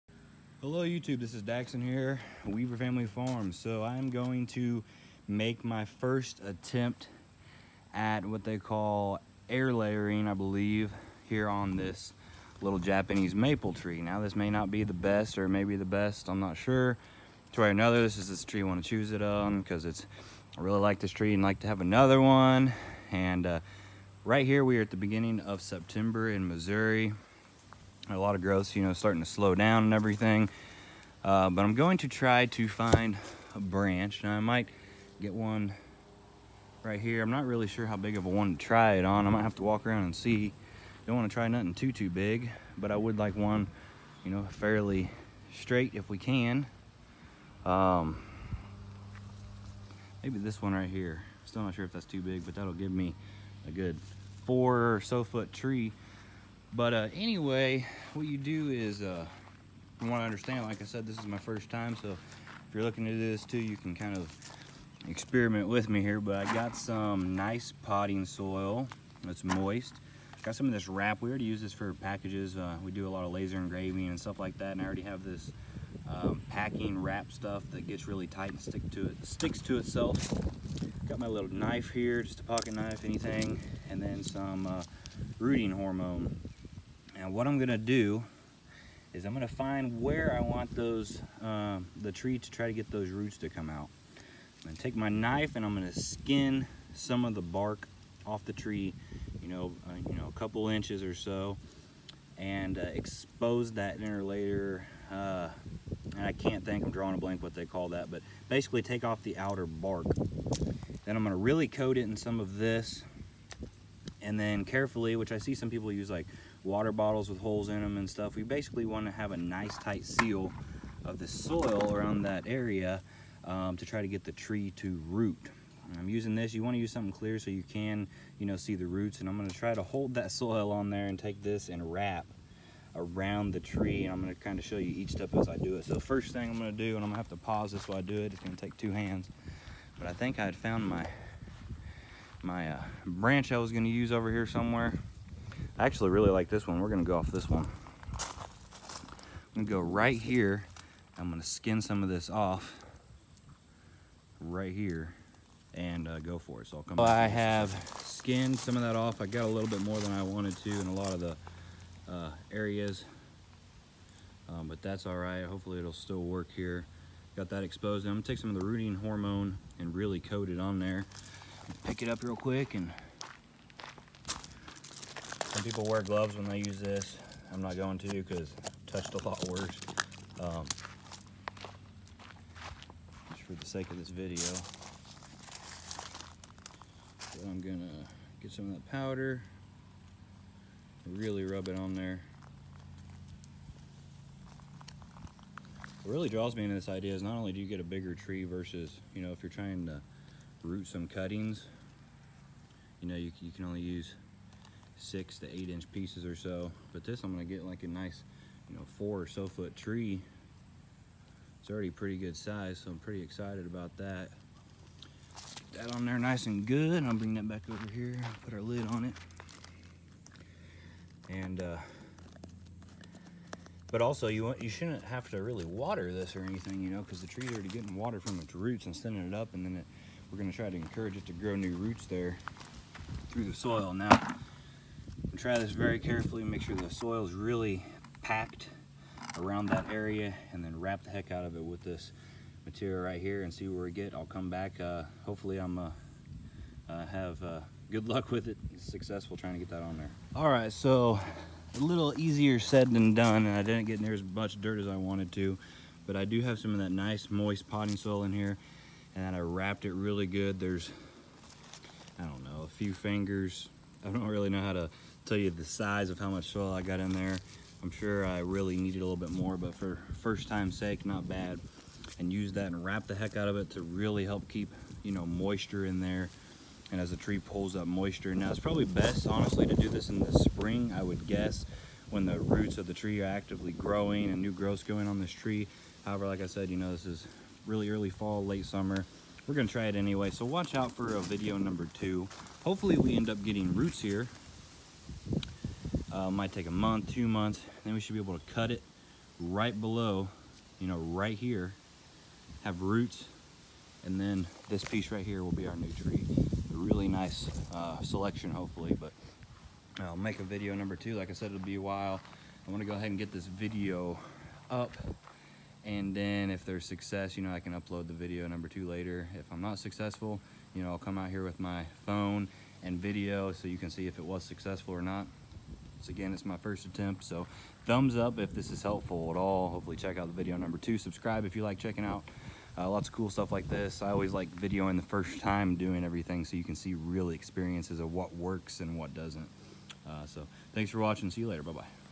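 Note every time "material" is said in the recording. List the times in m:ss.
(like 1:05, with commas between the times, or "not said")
4:02.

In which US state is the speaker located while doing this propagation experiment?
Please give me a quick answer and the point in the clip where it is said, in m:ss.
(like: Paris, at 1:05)
Missouri, at 0:26.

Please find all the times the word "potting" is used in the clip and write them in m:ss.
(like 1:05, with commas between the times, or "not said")
1:07, 4:17.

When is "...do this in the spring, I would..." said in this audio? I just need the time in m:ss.
4:39.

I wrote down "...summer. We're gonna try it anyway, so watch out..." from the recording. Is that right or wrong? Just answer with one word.
right.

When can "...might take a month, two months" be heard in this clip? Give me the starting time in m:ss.
4:56.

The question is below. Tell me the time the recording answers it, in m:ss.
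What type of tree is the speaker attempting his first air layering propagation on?
0:12.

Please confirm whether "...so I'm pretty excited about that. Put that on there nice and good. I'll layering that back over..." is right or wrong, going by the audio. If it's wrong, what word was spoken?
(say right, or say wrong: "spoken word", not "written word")
wrong: "bring", not "layering".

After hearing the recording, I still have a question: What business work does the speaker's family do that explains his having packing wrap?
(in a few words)
laser engraving.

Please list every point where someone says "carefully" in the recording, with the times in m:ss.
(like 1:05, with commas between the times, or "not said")
1:54, 3:55.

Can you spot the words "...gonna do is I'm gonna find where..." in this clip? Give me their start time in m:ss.
1:27.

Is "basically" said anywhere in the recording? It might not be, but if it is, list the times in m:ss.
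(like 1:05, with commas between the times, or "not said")
1:48, 1:58.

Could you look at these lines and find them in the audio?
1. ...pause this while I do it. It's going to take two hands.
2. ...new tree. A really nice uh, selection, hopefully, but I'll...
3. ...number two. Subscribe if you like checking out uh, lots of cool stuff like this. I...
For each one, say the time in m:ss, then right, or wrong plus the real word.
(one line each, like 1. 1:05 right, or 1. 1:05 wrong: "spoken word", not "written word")
1. 2:17 right
2. 5:05 right
3. 5:30 right.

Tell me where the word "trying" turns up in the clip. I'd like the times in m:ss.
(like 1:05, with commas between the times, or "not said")
3:19, 4:09.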